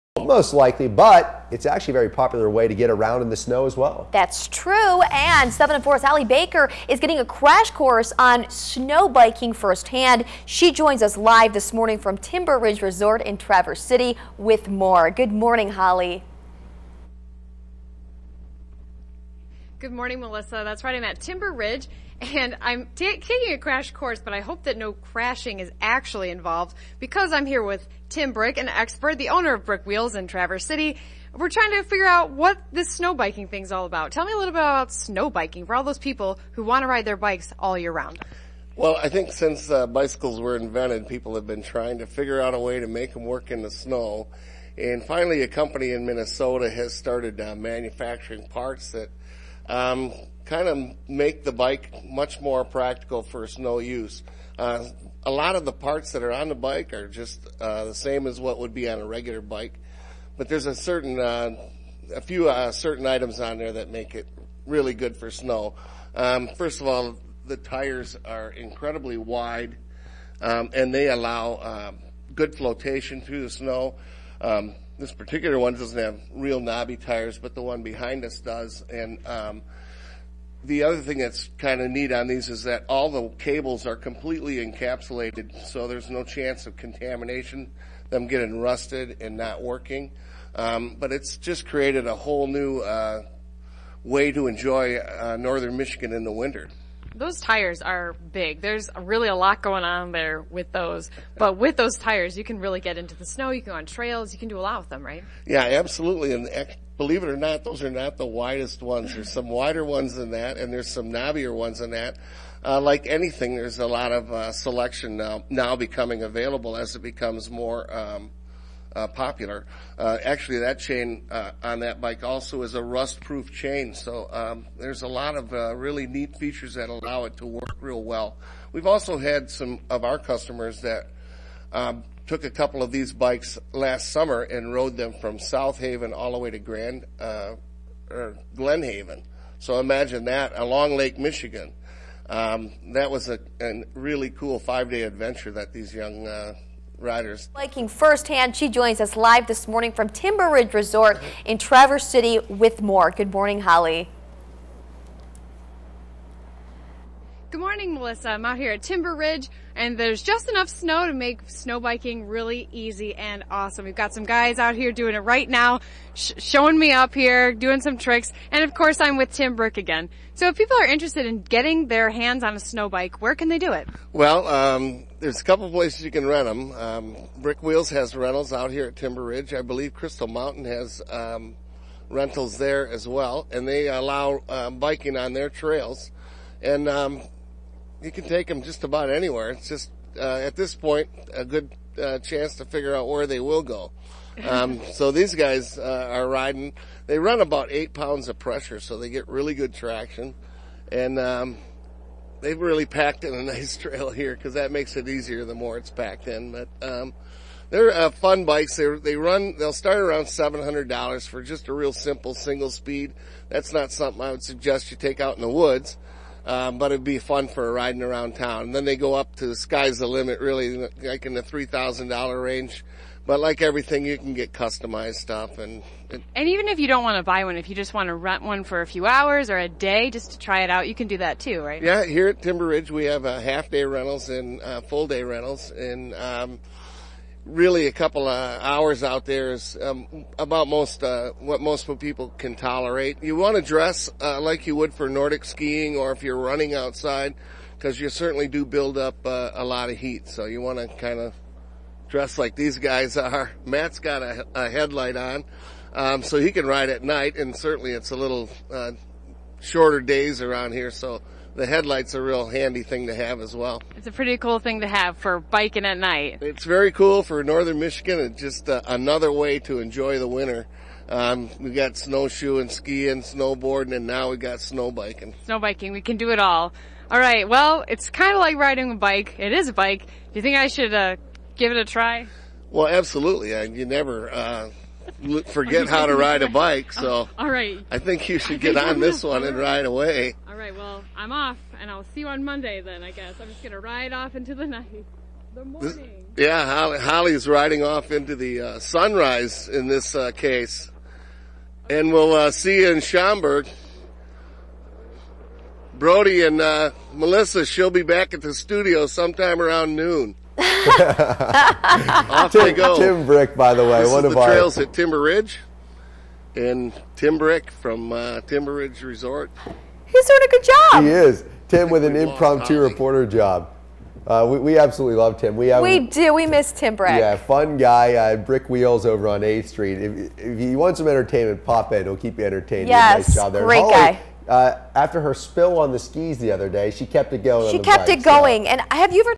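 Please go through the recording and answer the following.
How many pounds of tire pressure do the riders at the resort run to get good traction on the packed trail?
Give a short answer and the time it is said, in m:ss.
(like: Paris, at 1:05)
8, at 3:17.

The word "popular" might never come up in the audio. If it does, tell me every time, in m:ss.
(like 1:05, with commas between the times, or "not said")
0:02, 1:59.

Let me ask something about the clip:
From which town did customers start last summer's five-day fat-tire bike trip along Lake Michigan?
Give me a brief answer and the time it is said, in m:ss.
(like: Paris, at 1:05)
South Haven, at 2:15.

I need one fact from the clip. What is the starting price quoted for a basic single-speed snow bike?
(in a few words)
$700.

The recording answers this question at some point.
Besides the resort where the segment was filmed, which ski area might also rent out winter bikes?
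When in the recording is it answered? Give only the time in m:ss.
2:59.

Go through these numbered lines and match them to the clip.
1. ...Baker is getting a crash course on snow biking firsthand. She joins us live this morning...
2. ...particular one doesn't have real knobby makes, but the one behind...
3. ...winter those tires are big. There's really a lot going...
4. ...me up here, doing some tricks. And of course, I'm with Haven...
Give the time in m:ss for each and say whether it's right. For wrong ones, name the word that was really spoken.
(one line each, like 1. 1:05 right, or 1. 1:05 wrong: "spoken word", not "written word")
1. 0:06 right
2. 1:15 wrong: "tires", not "makes"
3. 1:36 right
4. 2:46 wrong: "Tim", not "Haven".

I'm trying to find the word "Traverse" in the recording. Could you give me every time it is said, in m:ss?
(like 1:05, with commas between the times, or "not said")
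0:13, 0:30, 2:31.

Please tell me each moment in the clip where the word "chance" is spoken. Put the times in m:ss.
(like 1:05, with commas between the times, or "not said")
1:26, 3:12.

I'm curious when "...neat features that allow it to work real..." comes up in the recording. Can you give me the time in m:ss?
2:06.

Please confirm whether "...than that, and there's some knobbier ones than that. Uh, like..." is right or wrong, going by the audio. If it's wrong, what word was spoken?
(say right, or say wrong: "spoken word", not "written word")
right.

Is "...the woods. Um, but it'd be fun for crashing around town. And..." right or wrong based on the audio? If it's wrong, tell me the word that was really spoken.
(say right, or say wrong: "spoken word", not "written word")
wrong: "riding", not "crashing".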